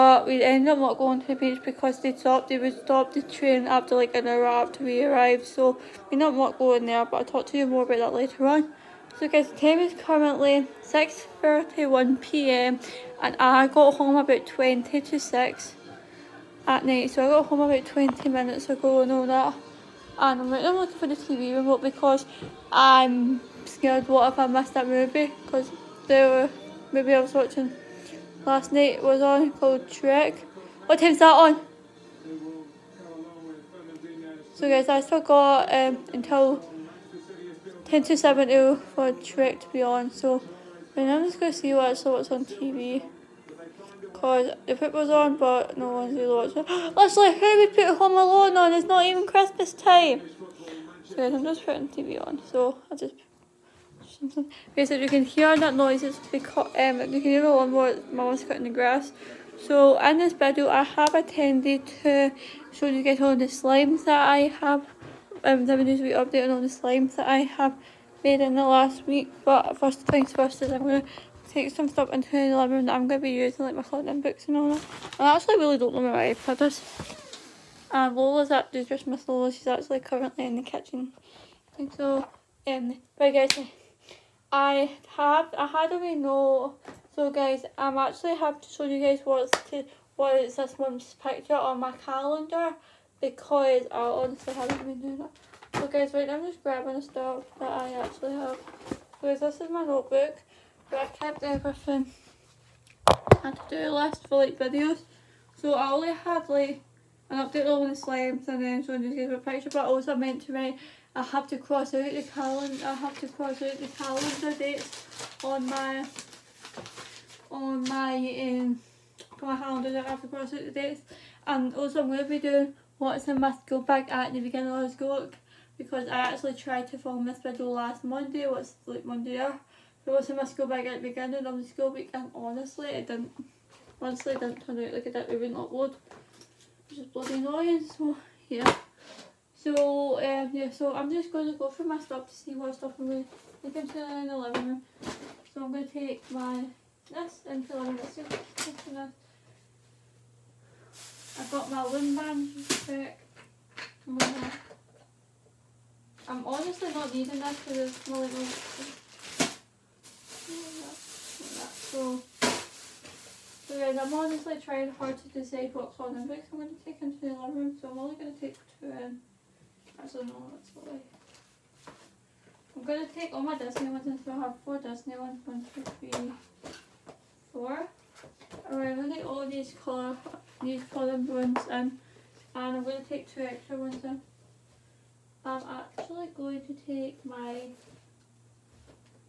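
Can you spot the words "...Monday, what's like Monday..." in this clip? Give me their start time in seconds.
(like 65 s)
128 s.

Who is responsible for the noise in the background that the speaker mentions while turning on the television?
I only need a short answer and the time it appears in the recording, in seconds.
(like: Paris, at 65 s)
Mom, at 58 s.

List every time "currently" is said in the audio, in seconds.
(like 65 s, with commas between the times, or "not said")
10 s, 80 s.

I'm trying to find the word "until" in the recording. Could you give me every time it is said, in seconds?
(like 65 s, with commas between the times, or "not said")
36 s, 174 s.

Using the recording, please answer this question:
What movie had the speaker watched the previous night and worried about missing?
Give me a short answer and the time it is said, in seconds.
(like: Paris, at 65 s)
Trek, at 29 s.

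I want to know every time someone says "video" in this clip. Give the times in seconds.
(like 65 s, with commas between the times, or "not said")
60 s, 104 s, 127 s.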